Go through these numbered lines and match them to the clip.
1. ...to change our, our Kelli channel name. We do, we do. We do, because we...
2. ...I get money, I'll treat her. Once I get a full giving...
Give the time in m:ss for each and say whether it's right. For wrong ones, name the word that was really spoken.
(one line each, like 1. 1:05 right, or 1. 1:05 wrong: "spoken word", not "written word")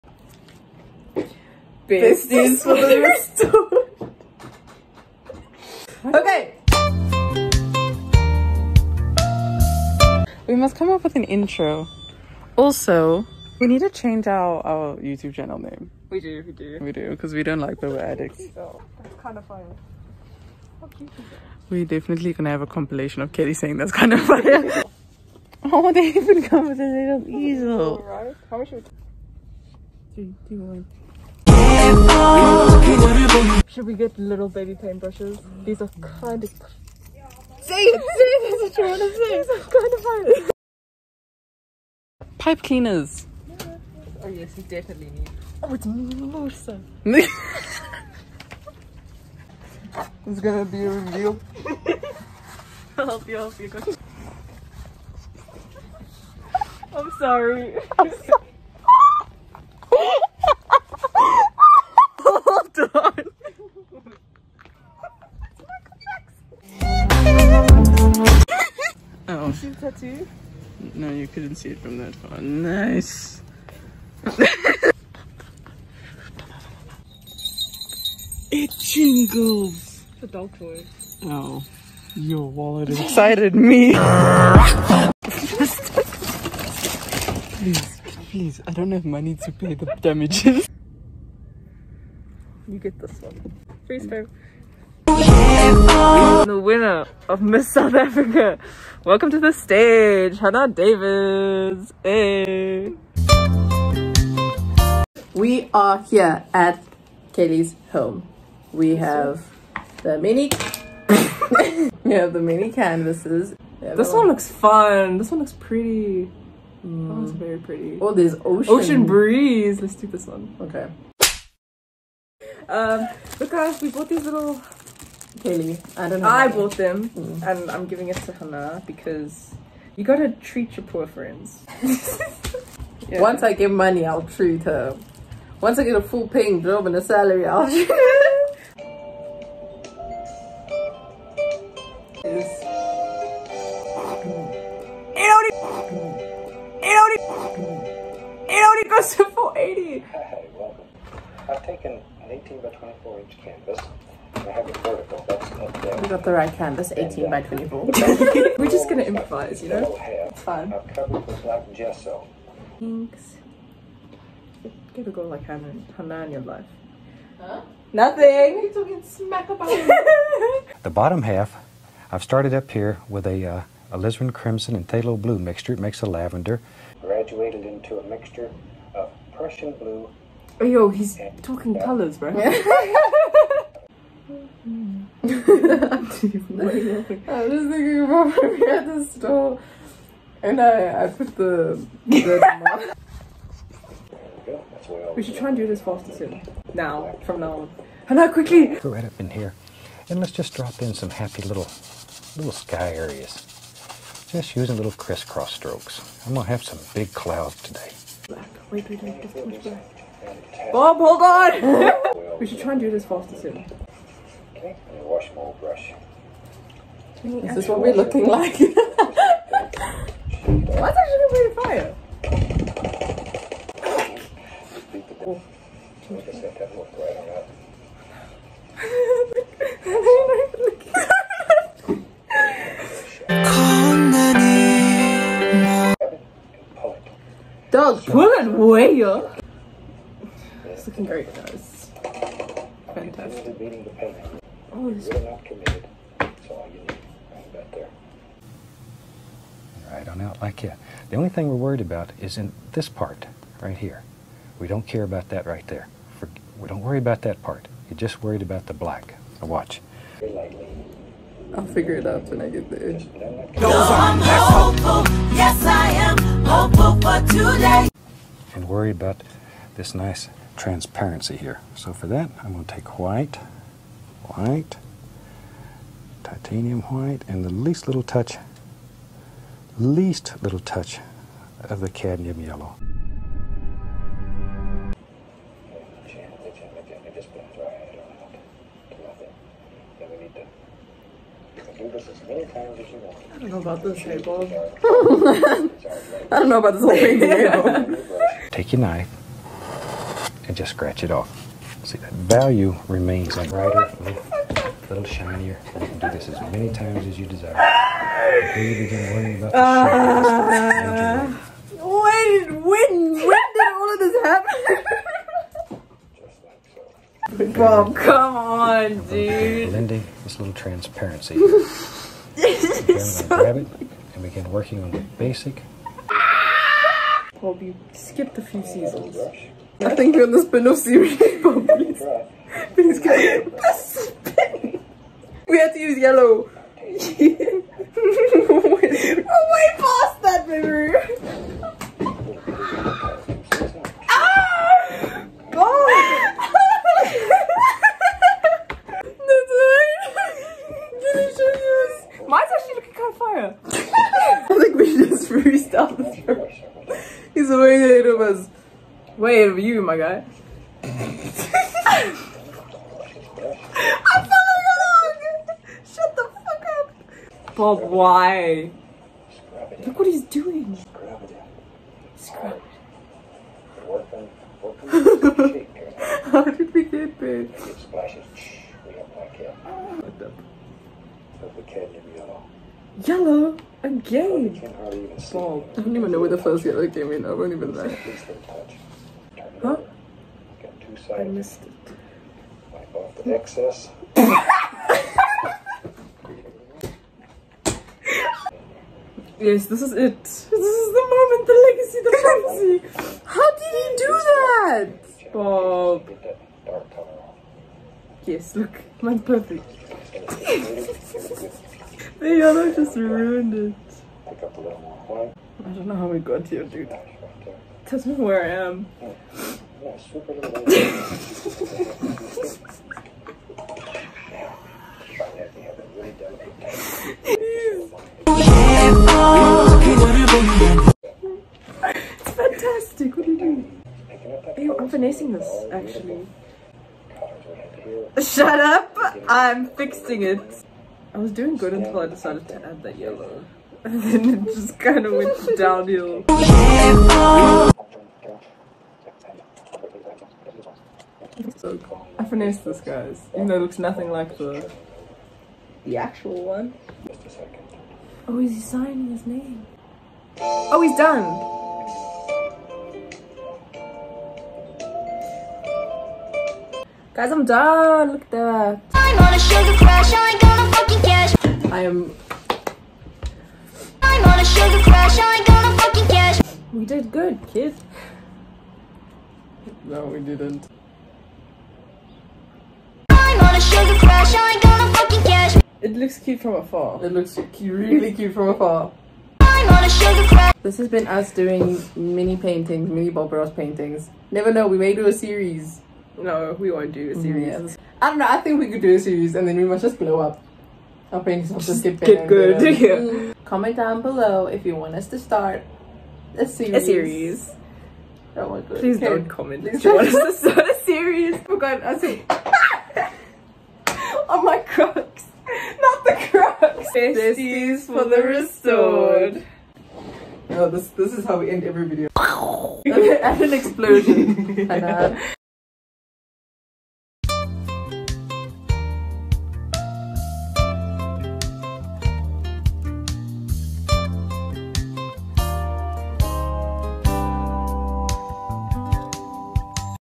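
1. 0:13 wrong: "YouTube", not "Kelli"
2. 2:13 wrong: "paying", not "giving".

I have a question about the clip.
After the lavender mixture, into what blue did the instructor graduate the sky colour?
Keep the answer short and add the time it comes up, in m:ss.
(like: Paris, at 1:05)
Prussian blue, at 2:59.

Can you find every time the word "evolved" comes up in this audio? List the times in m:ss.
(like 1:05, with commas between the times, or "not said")
not said.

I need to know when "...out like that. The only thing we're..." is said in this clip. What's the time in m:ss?
4:10.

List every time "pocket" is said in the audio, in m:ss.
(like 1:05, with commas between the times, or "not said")
not said.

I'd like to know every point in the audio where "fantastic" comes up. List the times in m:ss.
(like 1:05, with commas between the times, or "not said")
4:02, 7:12.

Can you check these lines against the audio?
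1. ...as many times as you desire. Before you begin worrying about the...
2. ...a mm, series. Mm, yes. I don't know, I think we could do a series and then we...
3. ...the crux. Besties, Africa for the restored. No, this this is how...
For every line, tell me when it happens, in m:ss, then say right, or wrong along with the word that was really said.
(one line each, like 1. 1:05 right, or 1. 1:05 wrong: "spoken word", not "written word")
1. 5:06 right
2. 8:17 right
3. 8:36 wrong: "Besties", not "Africa".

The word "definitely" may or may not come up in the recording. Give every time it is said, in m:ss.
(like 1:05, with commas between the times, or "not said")
0:21, 0:44.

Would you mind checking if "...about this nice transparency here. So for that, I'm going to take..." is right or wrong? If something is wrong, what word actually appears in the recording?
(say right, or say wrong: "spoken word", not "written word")
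right.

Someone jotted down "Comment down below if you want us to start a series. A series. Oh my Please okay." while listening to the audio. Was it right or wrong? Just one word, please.
right.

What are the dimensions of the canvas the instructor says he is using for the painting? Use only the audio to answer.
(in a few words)
18 by 24 inch.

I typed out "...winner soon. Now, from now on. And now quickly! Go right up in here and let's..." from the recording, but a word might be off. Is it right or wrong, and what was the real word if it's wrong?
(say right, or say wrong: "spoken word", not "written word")
wrong: "faster", not "winner".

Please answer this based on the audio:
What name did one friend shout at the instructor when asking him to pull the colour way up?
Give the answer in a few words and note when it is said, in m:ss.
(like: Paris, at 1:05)
Doug, at 3:57.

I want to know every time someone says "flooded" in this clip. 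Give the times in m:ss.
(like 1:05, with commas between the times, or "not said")
not said.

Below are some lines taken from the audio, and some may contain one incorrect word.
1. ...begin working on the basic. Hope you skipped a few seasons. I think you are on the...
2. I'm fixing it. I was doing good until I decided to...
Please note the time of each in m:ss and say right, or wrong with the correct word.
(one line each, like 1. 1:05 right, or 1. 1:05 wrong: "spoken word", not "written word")
1. 5:24 right
2. 7:19 right.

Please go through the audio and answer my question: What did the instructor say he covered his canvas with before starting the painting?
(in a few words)
black gesso.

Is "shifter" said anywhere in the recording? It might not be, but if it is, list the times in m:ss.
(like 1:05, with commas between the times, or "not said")
not said.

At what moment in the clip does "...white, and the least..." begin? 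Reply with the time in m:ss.
4:36.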